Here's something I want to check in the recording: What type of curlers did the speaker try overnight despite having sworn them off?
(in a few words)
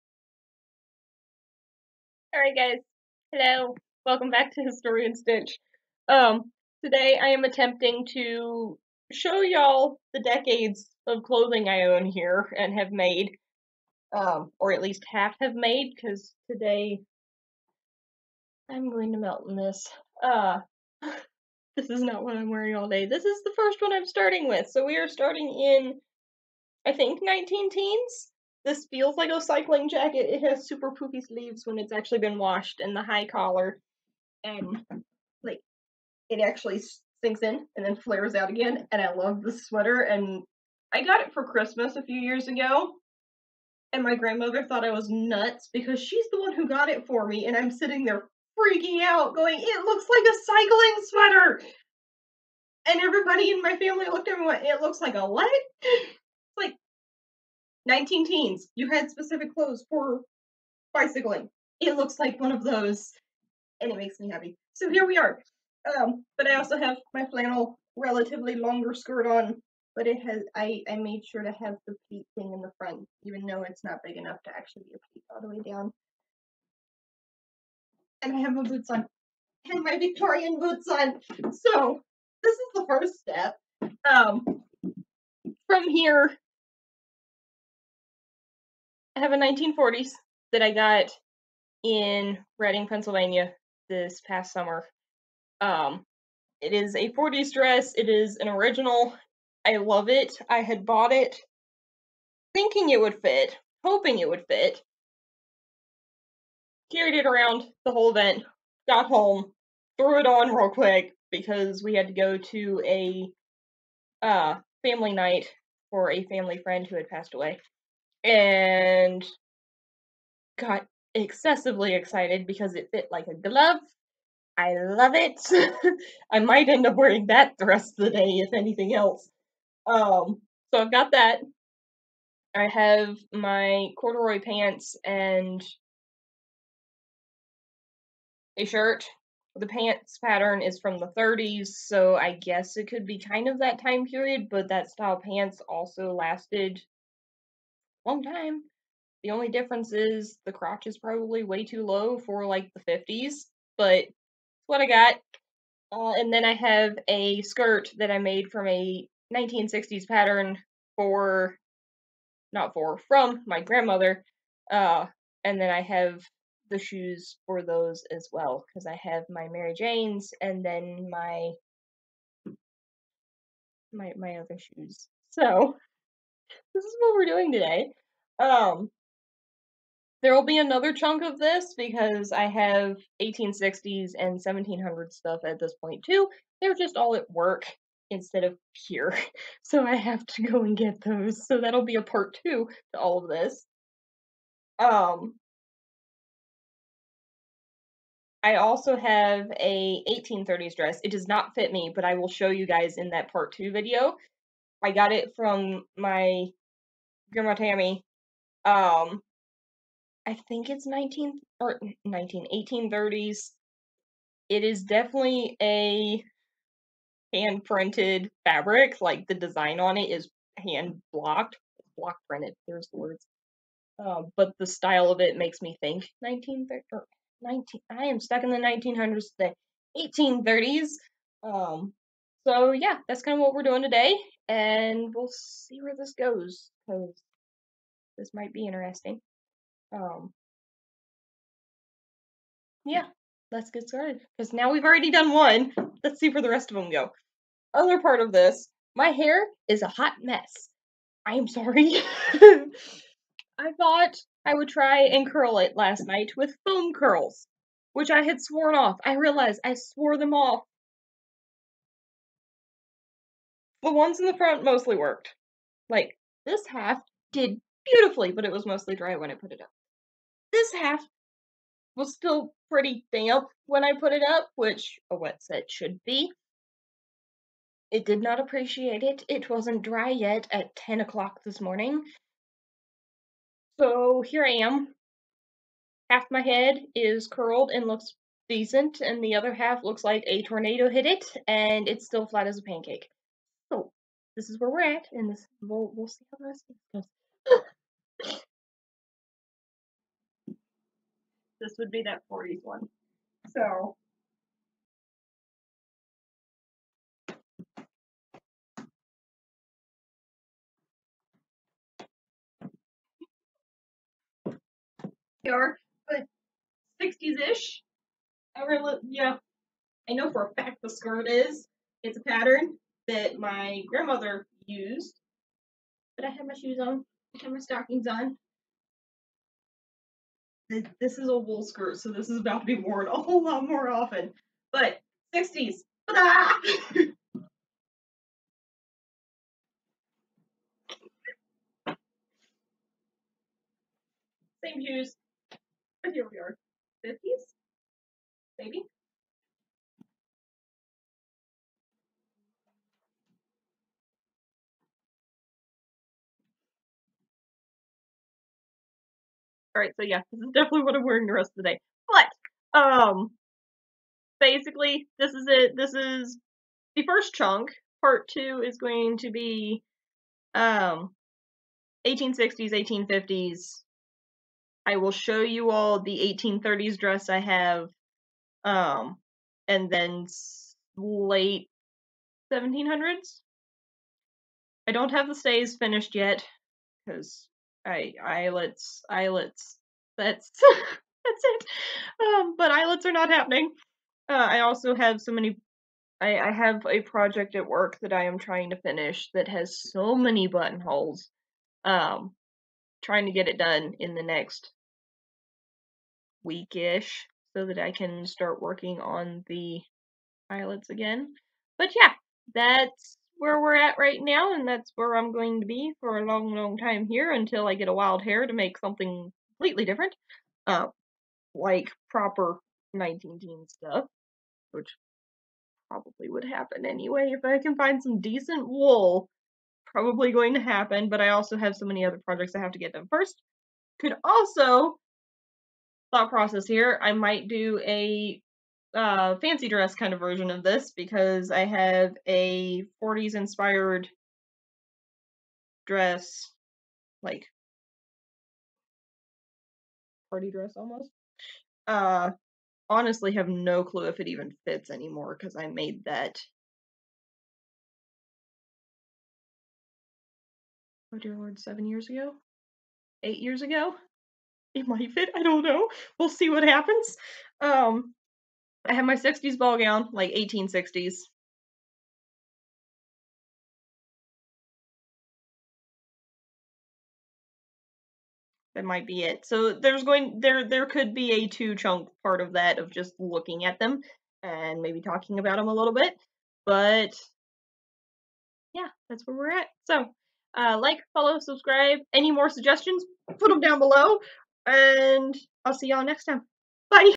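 foam curls.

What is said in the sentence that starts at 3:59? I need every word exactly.
Um, yeah, let's get started because now we've already done one.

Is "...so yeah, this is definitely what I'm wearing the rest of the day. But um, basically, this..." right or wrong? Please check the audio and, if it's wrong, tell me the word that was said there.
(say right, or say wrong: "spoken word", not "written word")
right.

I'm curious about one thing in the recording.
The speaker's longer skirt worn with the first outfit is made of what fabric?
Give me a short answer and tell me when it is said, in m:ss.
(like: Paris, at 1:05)
flannel, at 1:07.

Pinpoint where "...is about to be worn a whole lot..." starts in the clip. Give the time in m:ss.
5:32.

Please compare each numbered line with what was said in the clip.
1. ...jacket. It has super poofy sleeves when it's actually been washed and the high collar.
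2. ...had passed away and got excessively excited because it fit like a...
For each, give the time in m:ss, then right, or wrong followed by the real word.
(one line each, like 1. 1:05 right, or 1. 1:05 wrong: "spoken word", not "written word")
1. 0:29 right
2. 1:56 right.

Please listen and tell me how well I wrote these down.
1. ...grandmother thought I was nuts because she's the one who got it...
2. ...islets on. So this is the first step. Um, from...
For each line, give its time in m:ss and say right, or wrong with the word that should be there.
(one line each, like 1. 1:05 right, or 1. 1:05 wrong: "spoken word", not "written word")
1. 0:44 right
2. 1:20 wrong: "boots", not "islets".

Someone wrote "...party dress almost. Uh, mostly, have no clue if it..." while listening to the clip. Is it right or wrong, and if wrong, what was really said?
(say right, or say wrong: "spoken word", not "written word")
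wrong: "honestly", not "mostly".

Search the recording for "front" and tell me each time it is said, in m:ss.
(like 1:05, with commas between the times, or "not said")
1:12, 4:24.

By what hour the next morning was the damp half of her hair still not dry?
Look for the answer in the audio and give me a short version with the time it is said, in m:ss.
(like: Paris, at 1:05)
10 o'clock, at 4:40.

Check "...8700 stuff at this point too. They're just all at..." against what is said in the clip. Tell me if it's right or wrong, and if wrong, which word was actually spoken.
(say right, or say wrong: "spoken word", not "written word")
wrong: "1700", not "8700".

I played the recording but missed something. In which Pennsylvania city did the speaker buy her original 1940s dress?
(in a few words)
Reading.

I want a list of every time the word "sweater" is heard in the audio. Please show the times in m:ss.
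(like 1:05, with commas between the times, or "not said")
0:39, 0:51.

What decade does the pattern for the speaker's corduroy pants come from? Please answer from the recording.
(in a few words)
1930s.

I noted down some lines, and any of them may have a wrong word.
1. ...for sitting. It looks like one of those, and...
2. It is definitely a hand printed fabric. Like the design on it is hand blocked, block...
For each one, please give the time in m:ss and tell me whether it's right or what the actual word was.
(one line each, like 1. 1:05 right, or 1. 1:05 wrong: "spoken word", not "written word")
1. 0:59 wrong: "bicycling", not "sitting"
2. 3:34 right.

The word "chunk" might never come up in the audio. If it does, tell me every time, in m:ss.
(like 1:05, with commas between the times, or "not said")
3:00, 6:07, 8:01.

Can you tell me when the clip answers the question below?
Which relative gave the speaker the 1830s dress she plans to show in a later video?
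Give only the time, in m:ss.
3:27.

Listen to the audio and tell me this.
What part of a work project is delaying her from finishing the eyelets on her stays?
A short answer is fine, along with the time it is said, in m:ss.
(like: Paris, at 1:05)
buttonholes, at 6:40.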